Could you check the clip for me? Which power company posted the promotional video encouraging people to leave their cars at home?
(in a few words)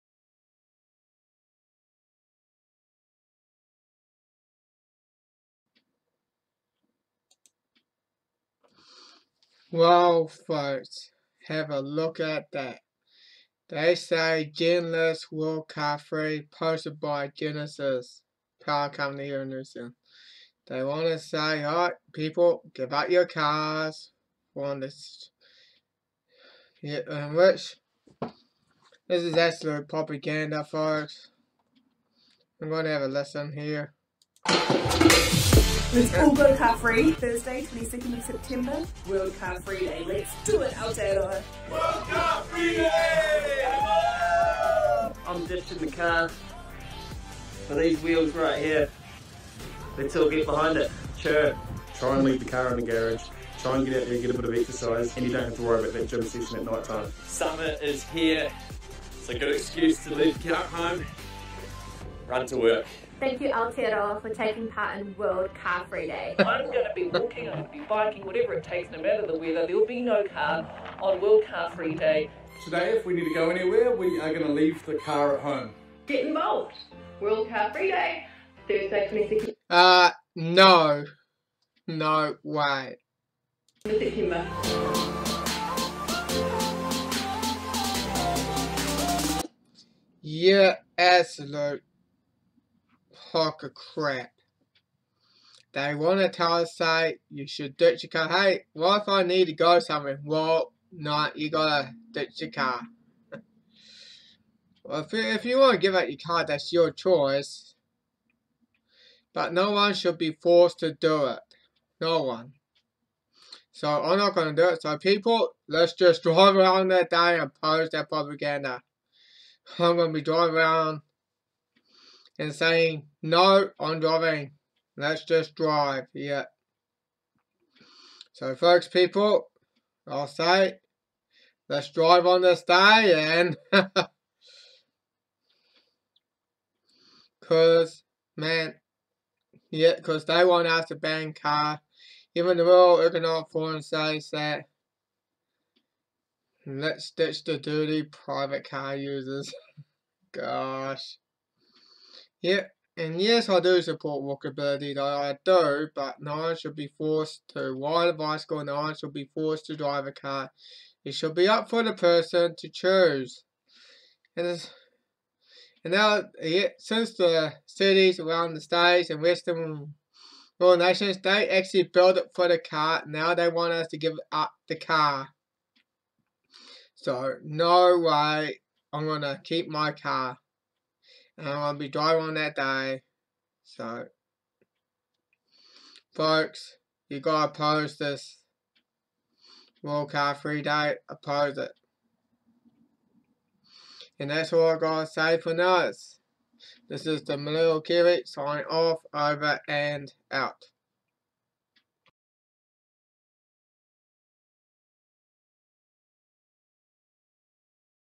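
Genesis Power Company.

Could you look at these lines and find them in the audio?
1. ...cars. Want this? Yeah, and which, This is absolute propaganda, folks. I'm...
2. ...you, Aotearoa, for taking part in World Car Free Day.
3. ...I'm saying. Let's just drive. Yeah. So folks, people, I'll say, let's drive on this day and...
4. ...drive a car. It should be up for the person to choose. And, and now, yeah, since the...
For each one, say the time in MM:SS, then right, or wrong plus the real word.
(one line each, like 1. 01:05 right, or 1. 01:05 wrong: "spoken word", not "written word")
1. 00:23 right
2. 01:03 right
3. 02:03 wrong: "driving", not "saying"
4. 02:39 right.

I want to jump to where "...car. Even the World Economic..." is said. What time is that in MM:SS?
02:21.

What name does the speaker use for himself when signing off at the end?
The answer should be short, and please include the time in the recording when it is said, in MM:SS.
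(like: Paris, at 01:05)
Malil Kiwi, at 03:17.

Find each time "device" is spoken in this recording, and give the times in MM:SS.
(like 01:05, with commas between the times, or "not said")
not said.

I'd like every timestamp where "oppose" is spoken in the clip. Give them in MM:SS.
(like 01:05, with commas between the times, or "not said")
01:57, 03:11.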